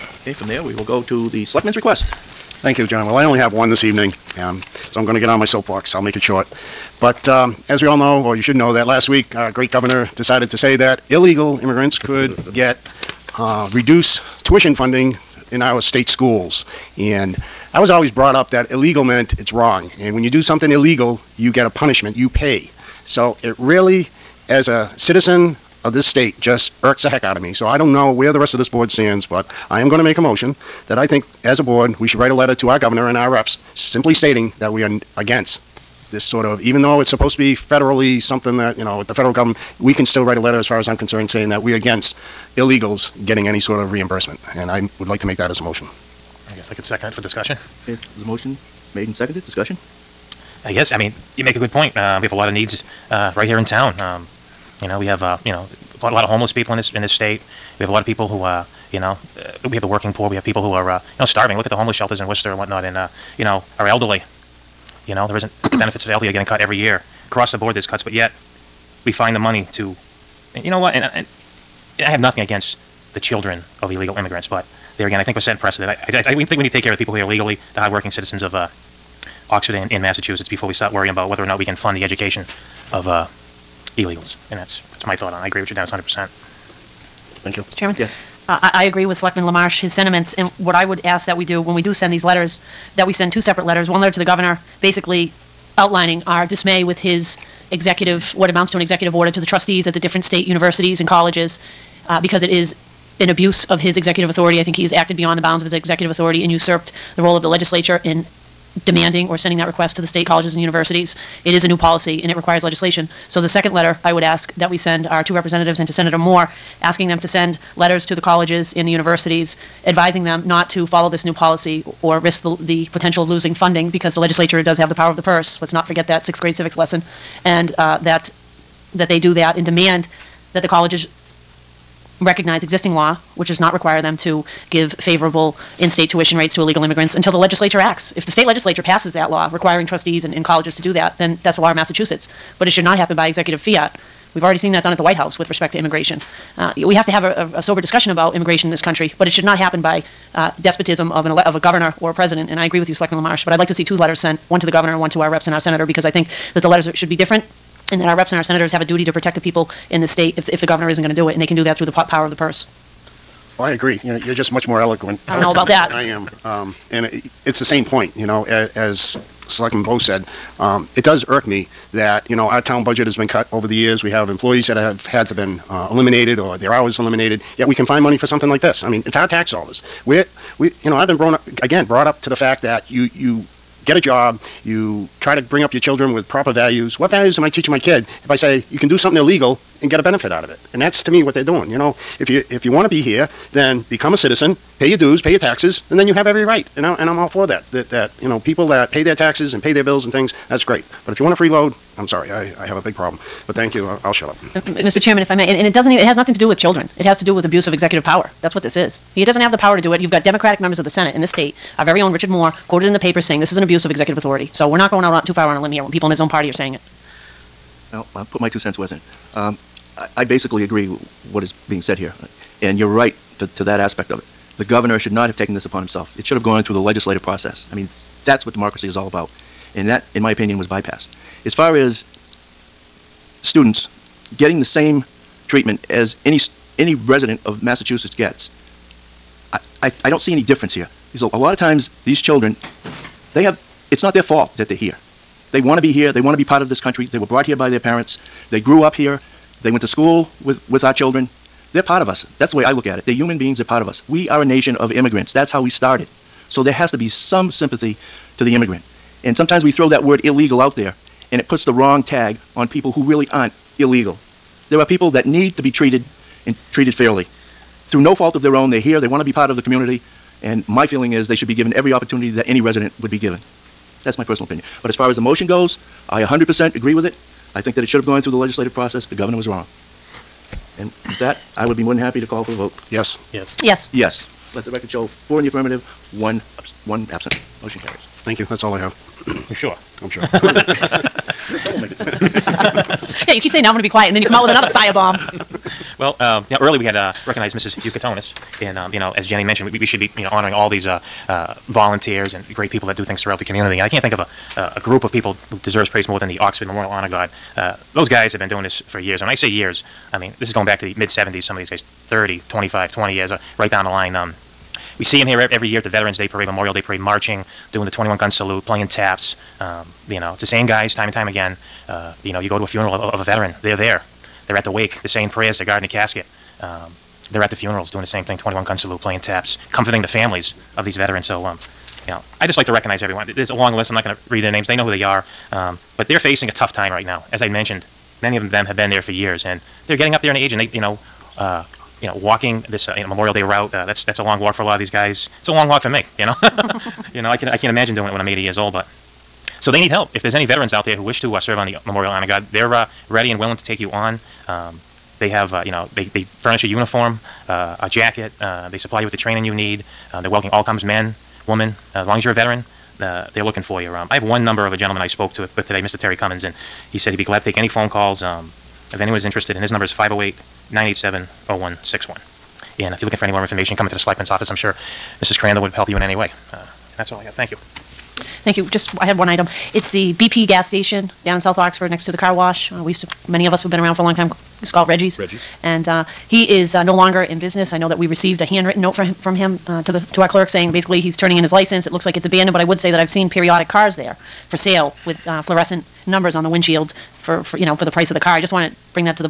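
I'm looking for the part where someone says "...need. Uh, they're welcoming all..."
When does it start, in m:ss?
5:59.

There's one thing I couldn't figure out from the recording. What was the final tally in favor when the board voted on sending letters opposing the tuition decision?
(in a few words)
4.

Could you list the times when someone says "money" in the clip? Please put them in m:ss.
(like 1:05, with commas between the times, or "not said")
1:09, 2:58.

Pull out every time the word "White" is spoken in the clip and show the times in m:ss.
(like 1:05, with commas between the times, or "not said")
2:25.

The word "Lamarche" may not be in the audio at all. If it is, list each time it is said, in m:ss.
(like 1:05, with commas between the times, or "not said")
1:29, 2:33.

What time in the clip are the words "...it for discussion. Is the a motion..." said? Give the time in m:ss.
0:47.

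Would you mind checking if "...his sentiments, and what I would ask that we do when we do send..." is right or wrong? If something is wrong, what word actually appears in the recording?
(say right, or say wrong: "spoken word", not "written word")
right.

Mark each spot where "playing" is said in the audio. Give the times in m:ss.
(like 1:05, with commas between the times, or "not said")
5:18, 5:29.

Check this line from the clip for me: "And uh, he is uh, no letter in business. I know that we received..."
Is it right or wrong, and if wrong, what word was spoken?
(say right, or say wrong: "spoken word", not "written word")
wrong: "longer", not "letter".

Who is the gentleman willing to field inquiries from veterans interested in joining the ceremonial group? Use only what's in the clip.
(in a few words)
Terry Cummins.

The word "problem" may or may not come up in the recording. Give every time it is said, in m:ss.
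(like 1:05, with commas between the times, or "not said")
3:22.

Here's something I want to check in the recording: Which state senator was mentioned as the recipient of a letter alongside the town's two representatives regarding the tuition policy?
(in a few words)
Senator Moore.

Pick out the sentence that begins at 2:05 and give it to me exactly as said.
Let's not forget that sixth grade civics lesson.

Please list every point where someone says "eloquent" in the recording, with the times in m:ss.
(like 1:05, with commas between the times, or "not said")
2:44.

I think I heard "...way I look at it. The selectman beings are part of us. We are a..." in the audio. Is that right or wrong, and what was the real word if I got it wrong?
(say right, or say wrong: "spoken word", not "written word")
wrong: "human", not "selectman".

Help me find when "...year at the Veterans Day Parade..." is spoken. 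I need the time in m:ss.
5:15.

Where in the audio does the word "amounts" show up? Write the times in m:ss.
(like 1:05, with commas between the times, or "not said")
1:38.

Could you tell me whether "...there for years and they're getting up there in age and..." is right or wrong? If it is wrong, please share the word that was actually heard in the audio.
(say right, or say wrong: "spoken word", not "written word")
right.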